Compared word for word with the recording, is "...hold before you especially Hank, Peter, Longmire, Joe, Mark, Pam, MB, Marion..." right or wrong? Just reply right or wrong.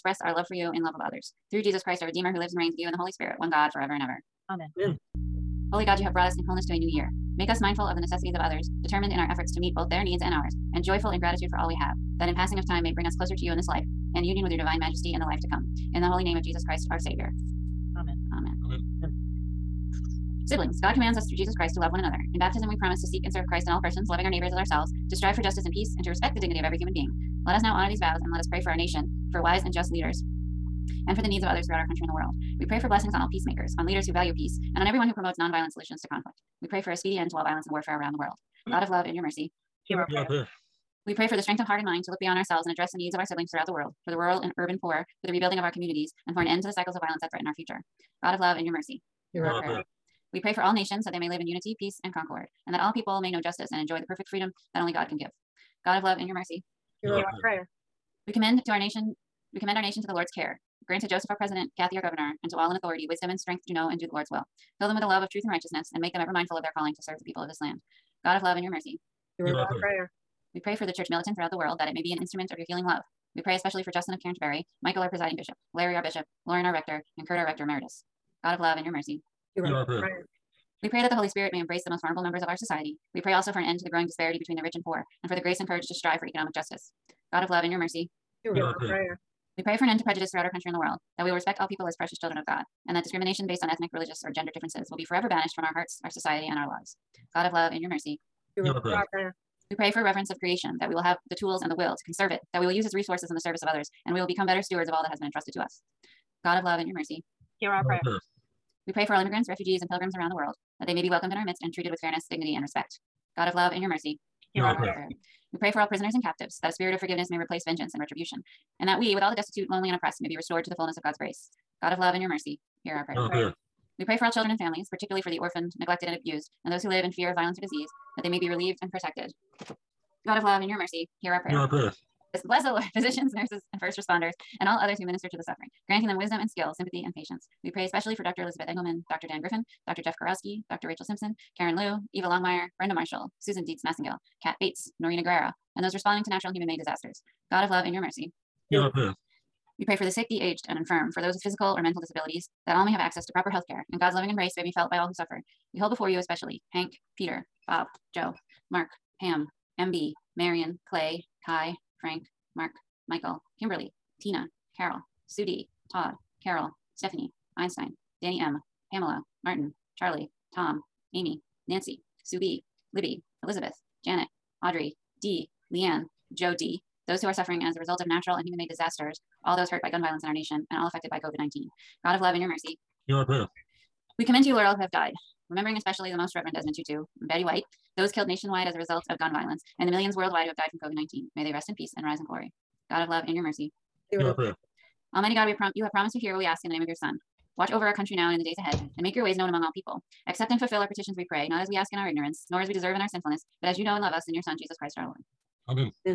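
wrong.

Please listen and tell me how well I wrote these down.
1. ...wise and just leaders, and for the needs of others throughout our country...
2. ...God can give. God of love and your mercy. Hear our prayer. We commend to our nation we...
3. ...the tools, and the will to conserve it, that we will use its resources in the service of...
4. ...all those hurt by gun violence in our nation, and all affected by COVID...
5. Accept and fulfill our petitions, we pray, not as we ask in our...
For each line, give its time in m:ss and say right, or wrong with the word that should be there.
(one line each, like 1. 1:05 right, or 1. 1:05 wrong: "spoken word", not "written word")
1. 0:29 right
2. 0:54 right
3. 1:41 right
4. 2:59 right
5. 3:20 right.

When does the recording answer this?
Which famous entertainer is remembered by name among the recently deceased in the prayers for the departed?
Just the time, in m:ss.
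3:07.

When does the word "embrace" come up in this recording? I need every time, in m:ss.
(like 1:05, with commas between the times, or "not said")
1:21, 2:34.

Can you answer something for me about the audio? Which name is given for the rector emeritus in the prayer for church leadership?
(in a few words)
Kurt.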